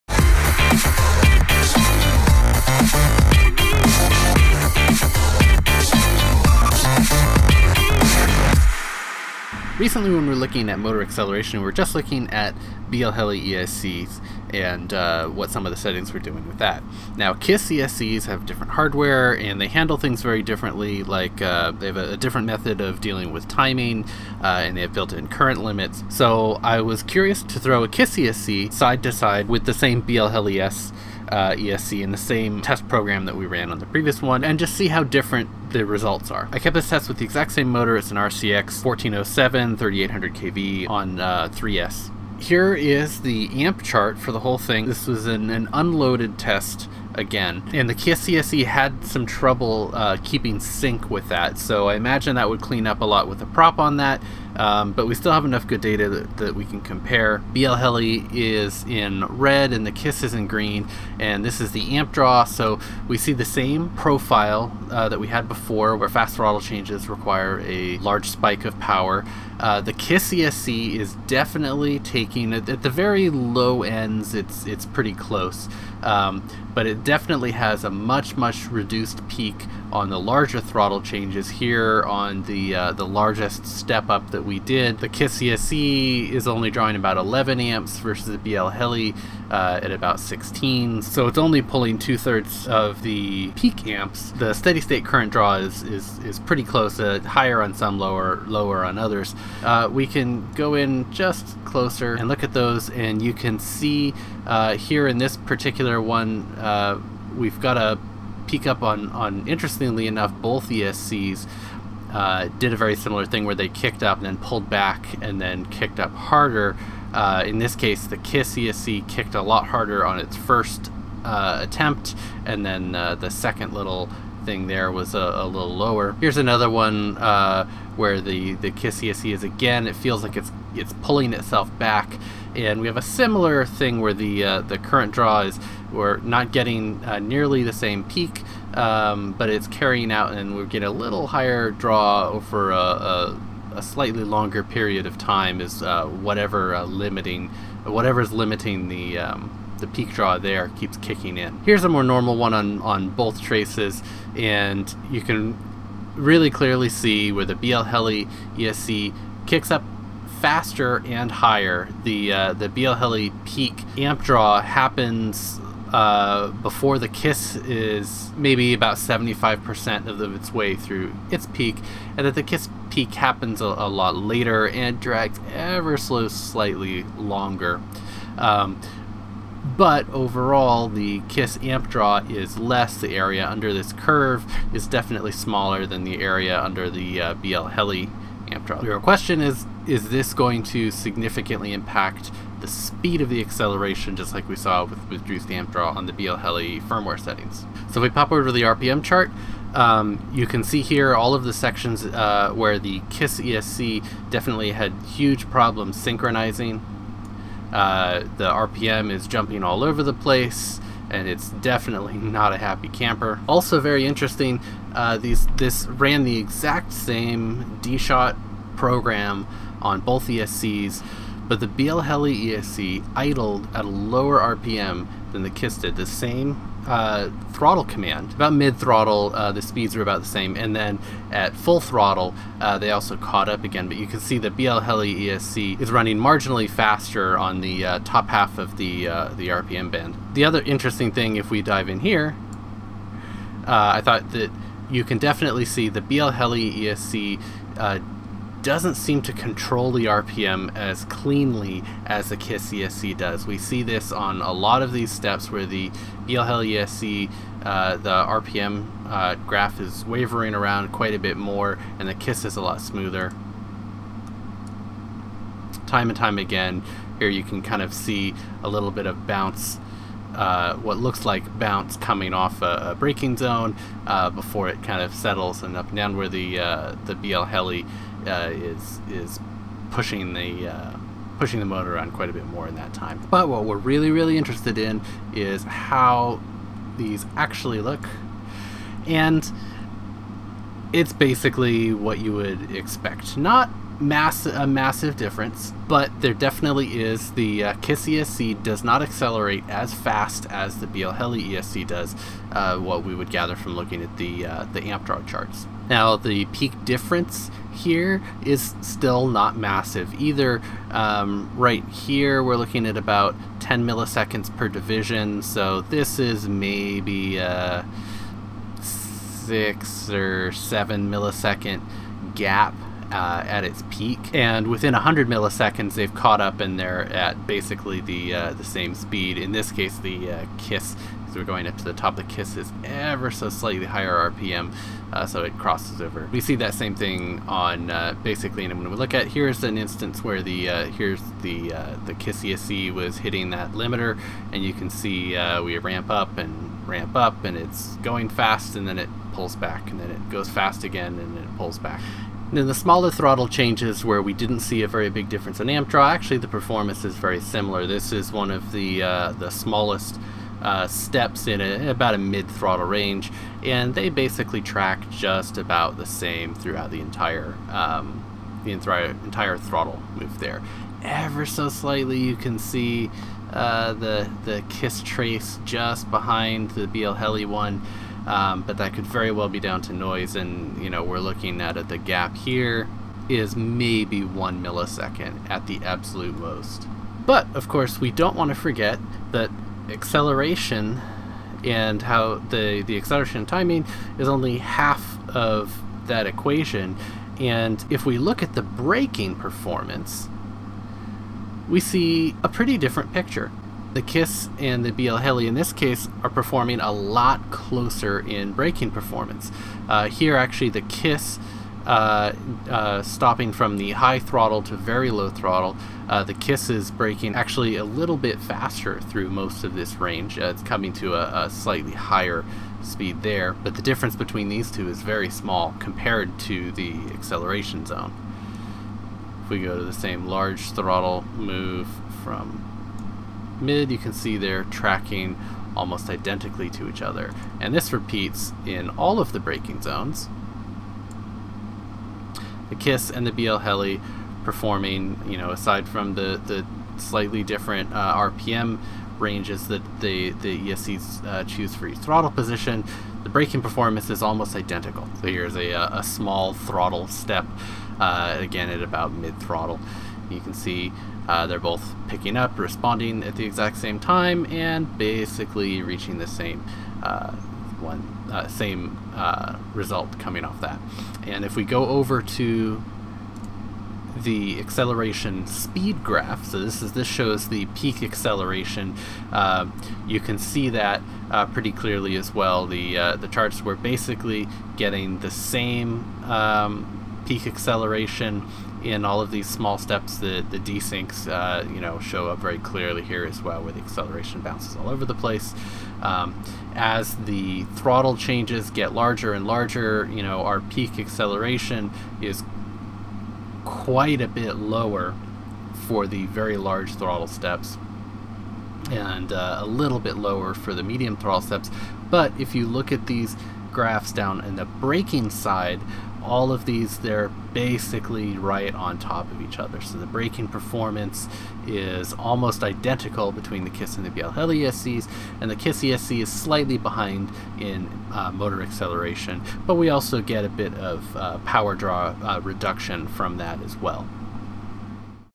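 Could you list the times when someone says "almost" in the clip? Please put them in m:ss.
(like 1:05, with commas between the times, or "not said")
7:15, 7:34, 8:42.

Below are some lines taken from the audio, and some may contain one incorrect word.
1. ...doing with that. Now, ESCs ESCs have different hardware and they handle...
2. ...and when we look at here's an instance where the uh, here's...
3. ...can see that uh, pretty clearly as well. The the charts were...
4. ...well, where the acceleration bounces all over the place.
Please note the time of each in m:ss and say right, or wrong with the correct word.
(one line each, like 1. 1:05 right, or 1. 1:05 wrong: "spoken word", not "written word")
1. 0:16 wrong: "KISS", not "ESCs"
2. 5:38 right
3. 8:00 right
4. 8:13 right.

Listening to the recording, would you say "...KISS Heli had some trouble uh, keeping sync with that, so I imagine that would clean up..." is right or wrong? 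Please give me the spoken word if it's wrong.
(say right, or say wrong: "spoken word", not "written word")
wrong: "ESC", not "Heli".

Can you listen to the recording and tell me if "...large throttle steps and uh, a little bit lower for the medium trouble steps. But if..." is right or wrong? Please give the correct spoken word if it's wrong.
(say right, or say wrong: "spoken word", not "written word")
wrong: "throttle", not "trouble".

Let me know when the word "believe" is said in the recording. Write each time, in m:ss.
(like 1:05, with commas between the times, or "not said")
not said.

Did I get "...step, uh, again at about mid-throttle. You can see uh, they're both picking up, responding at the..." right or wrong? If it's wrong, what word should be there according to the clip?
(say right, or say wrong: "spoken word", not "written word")
right.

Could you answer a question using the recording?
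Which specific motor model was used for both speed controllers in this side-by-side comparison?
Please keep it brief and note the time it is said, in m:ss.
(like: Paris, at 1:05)
RCX 1407 3800, at 0:38.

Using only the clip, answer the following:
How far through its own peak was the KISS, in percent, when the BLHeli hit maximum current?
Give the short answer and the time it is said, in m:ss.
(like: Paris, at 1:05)
75%, at 2:48.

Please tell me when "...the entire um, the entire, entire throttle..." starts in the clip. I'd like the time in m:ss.
6:06.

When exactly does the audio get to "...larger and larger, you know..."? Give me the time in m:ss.
8:18.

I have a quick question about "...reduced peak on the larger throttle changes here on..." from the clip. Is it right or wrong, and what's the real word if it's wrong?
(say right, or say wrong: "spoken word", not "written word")
right.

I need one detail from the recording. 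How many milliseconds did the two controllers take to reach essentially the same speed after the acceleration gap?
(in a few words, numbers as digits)
100 milliseconds.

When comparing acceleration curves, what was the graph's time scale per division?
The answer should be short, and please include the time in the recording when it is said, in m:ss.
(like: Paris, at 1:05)
10 milliseconds, at 5:13.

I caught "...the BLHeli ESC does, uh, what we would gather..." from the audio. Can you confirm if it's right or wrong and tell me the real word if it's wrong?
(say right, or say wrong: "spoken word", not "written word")
right.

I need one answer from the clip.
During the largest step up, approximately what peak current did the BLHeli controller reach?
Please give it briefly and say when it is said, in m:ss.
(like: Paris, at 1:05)
16 amps, at 1:29.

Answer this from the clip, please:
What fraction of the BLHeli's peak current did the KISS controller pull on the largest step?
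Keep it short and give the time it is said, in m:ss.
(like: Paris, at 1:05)
two-thirds, at 1:31.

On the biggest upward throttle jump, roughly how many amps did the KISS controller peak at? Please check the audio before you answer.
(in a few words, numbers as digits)
11 amps.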